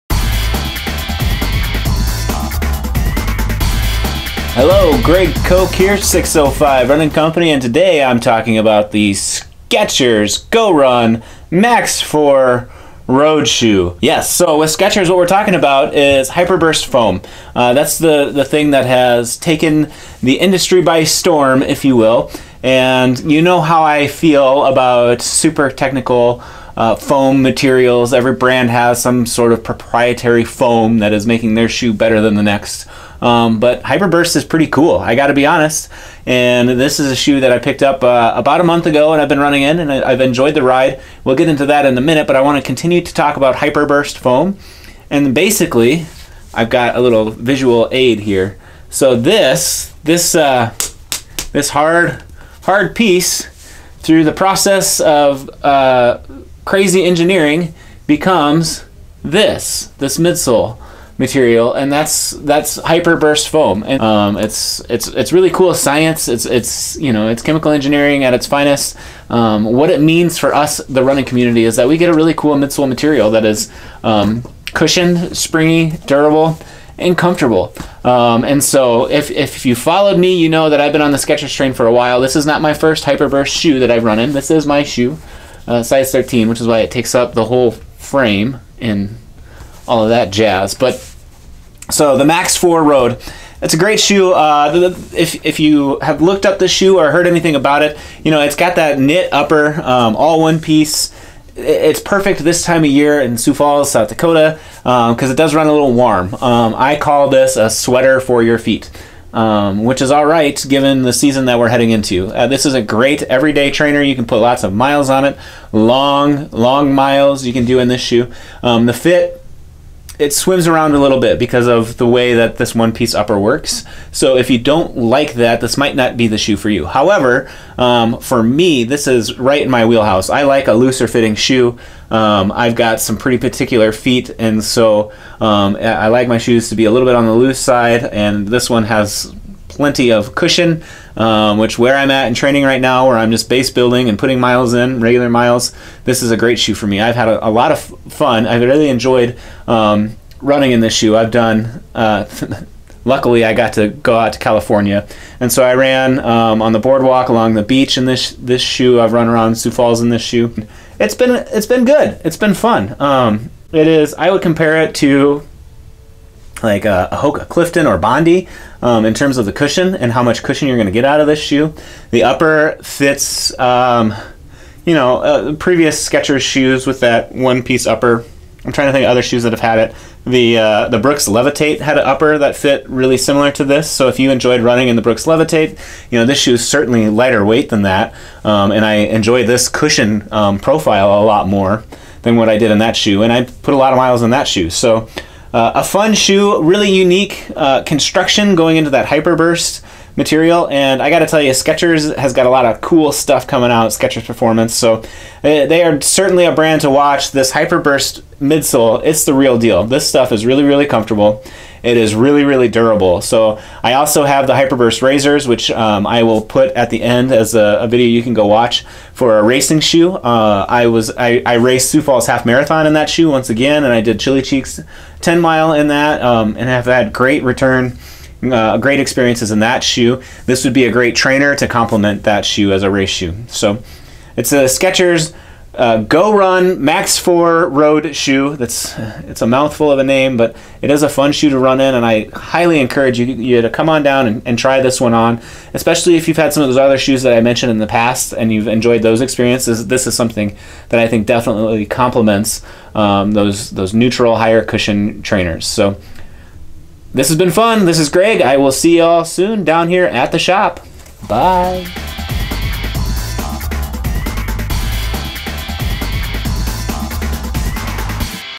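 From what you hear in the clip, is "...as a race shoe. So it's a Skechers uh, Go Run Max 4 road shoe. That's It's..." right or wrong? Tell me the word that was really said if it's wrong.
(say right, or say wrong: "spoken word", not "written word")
right.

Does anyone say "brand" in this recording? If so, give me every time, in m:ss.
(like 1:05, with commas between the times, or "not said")
0:28, 3:26.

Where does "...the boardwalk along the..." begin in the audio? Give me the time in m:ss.
2:36.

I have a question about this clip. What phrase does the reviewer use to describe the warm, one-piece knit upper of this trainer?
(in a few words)
A sweater for your feet.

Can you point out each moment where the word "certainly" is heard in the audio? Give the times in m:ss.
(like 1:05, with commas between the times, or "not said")
3:06, 3:26.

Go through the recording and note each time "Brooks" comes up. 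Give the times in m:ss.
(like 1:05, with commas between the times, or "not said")
3:00, 3:05.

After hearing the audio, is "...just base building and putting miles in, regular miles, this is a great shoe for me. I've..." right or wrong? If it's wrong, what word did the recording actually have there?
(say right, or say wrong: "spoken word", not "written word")
right.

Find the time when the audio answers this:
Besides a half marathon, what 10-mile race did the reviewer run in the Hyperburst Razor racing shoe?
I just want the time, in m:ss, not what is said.
3:44.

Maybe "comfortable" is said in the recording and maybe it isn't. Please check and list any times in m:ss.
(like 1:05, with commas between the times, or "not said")
1:17, 3:30.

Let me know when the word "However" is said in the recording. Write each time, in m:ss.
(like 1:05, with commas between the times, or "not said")
2:06.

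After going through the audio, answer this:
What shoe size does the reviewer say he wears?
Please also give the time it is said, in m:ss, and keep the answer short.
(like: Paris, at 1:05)
13, at 1:25.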